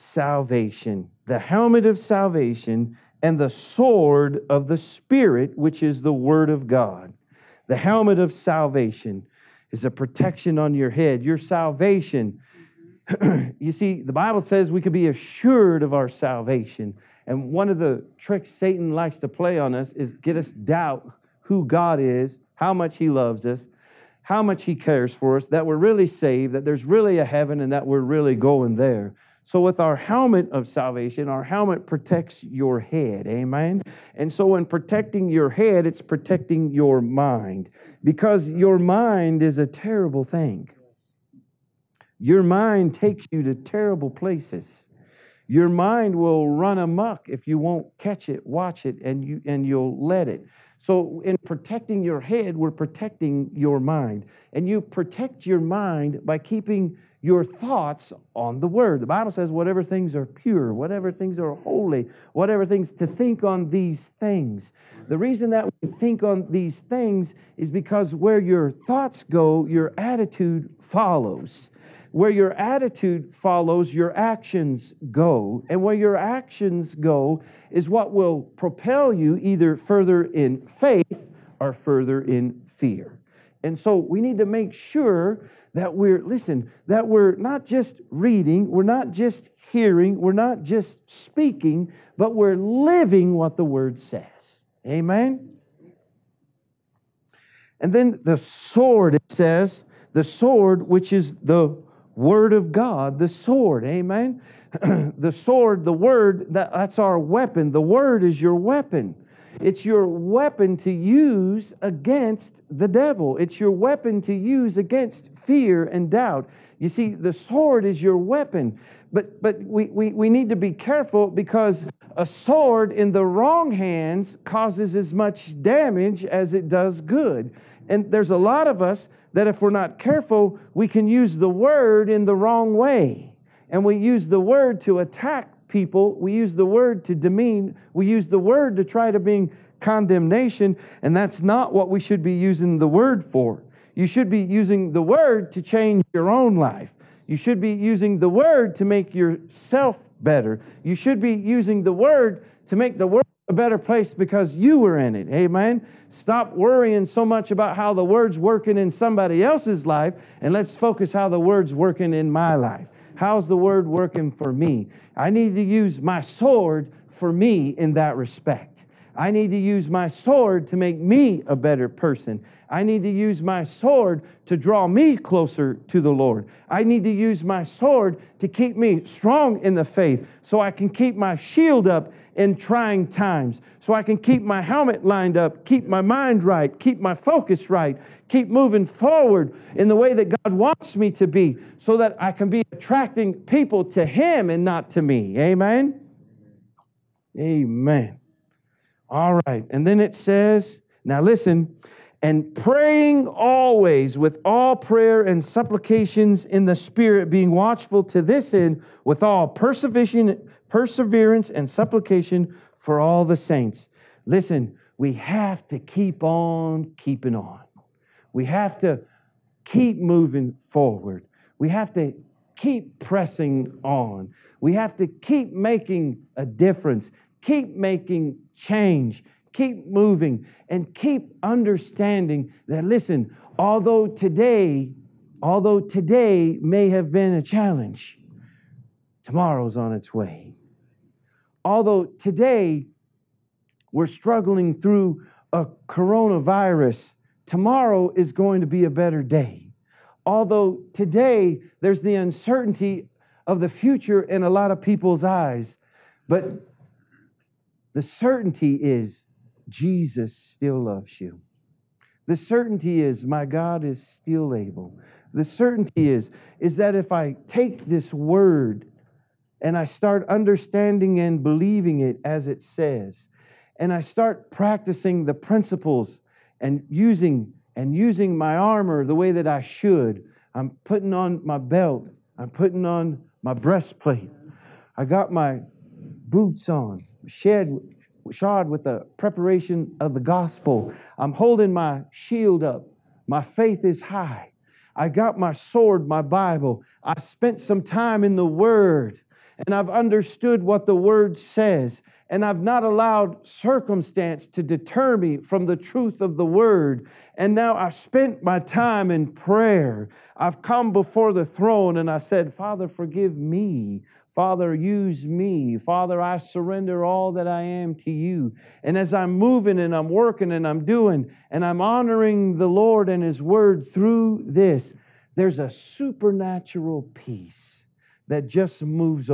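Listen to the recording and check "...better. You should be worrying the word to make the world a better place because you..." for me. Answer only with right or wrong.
wrong.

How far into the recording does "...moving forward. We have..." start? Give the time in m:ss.
3:40.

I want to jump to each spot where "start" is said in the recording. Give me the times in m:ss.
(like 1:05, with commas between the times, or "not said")
4:29, 4:34.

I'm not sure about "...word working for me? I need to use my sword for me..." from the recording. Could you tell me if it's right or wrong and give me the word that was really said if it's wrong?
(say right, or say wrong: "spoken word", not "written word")
right.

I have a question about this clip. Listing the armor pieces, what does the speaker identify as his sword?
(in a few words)
my Bible.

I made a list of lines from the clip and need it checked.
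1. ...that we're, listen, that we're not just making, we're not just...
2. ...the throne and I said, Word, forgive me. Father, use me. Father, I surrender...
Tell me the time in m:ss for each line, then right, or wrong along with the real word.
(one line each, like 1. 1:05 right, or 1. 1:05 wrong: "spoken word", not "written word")
1. 1:25 wrong: "reading", not "making"
2. 5:11 wrong: "Father", not "Word".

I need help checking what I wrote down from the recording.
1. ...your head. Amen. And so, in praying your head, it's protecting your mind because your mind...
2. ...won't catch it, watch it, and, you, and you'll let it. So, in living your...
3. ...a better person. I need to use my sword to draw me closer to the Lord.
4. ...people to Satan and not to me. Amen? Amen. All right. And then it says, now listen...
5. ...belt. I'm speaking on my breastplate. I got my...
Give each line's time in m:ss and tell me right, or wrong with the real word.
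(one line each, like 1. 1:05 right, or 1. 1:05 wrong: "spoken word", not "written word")
1. 0:32 wrong: "protecting", not "praying"
2. 0:47 wrong: "protecting", not "living"
3. 2:51 right
4. 3:13 wrong: "Him", not "Satan"
5. 4:41 wrong: "putting", not "speaking".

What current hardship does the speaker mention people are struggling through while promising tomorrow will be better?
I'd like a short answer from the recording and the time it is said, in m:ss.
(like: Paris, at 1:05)
coronavirus, at 4:05.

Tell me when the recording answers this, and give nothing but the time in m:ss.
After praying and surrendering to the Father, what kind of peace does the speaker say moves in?
5:25.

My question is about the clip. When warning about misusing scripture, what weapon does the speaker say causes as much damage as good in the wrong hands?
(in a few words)
a sword.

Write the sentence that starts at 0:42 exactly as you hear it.
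Your mind takes you to terrible places.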